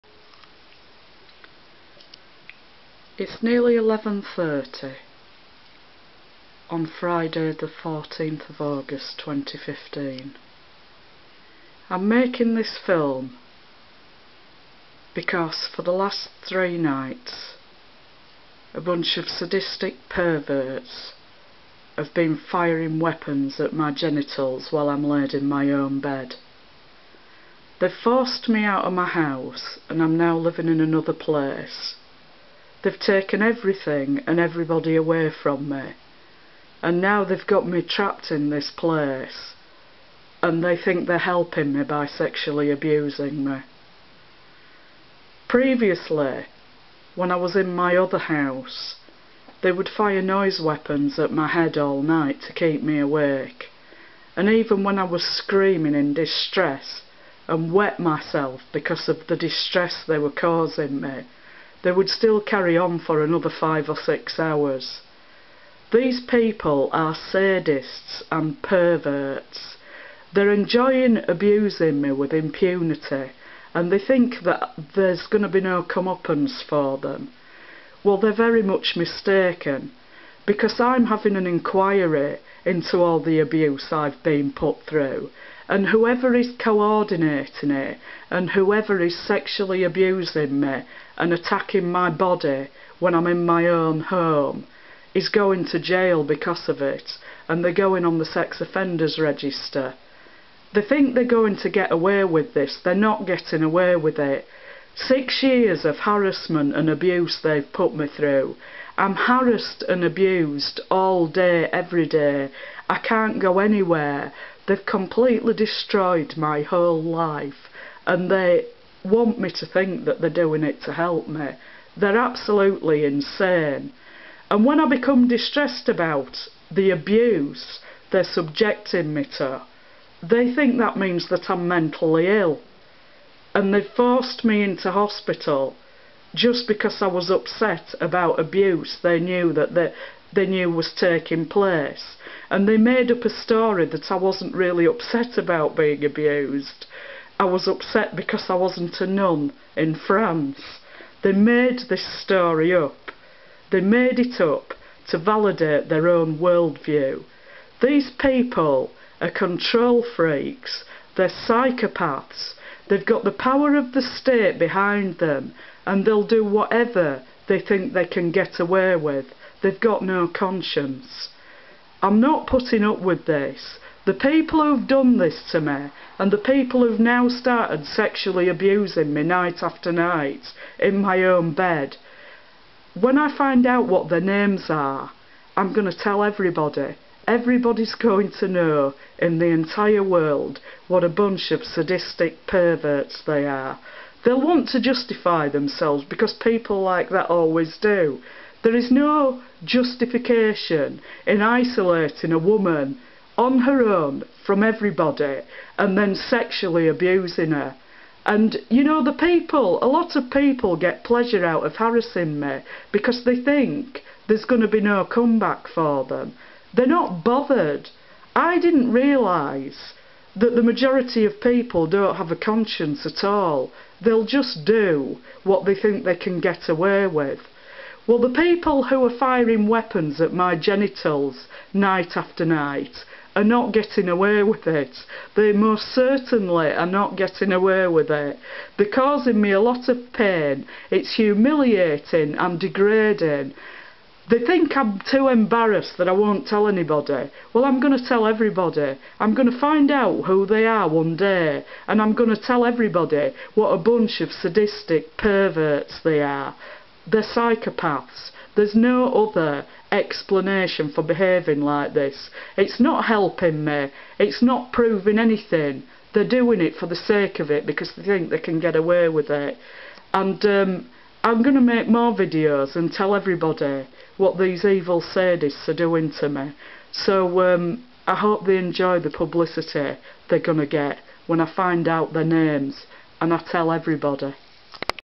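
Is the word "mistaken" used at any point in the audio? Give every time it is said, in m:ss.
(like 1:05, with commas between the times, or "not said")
1:18.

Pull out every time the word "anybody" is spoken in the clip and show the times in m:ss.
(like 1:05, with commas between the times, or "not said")
4:06.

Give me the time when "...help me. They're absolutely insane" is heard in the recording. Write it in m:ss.
2:00.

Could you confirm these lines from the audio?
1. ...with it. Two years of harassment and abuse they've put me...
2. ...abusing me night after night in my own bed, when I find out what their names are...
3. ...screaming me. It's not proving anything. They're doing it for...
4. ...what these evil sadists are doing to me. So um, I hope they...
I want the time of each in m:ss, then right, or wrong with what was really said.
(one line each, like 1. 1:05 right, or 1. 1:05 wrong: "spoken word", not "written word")
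1. 1:43 wrong: "Six", not "Two"
2. 2:58 right
3. 4:23 wrong: "helping", not "screaming"
4. 4:34 right.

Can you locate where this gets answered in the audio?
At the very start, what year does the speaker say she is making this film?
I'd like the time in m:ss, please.
0:09.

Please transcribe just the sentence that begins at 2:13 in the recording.
And they've forced me into hospital just because I was upset about abuse.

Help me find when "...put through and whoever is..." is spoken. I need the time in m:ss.
1:24.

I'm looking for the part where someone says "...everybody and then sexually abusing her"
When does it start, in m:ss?
3:24.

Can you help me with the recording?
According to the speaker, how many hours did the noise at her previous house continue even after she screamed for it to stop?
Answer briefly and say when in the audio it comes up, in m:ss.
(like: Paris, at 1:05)
5 or 6, at 1:03.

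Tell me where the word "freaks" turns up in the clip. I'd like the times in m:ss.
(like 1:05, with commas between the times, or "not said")
2:40.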